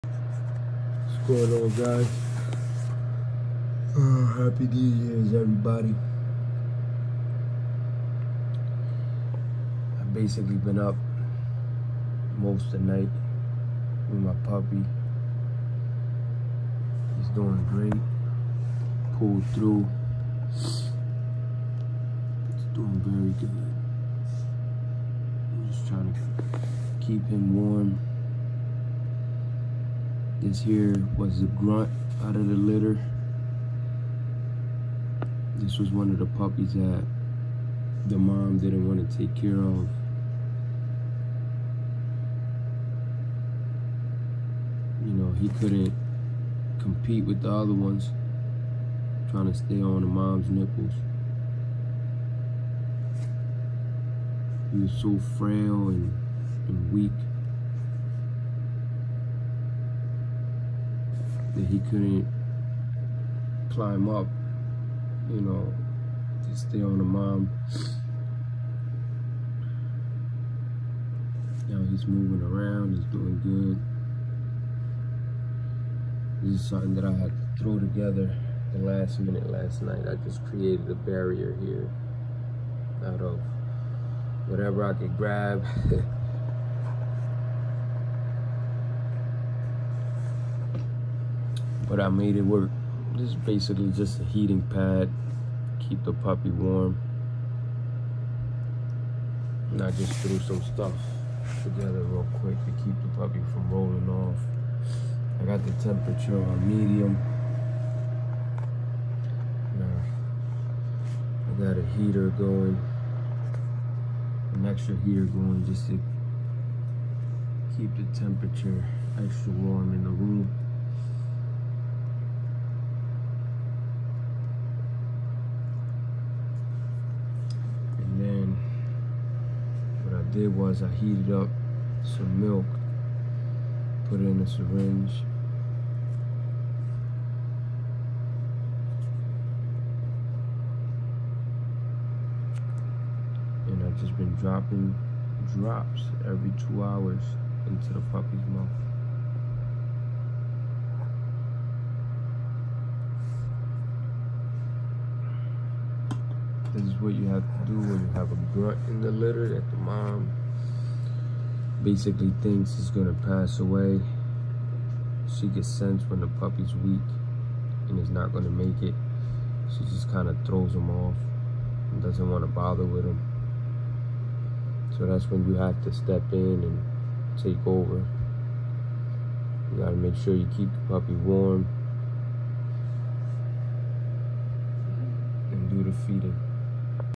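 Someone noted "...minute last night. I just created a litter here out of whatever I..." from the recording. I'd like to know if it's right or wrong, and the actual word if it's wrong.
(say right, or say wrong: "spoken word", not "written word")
wrong: "barrier", not "litter".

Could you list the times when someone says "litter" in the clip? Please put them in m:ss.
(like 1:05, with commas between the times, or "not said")
0:32, 2:39.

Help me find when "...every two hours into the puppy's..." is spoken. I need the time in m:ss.
2:26.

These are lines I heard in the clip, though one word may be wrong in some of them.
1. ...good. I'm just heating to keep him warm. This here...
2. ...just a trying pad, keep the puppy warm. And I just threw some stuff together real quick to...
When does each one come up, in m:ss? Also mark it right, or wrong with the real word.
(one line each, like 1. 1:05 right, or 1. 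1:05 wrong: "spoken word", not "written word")
1. 0:23 wrong: "trying", not "heating"
2. 1:33 wrong: "heating", not "trying".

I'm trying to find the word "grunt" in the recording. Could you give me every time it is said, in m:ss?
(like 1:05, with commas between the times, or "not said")
0:31, 2:38.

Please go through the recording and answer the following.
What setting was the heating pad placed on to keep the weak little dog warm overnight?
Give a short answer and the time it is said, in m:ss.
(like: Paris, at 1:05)
Medium, at 1:46.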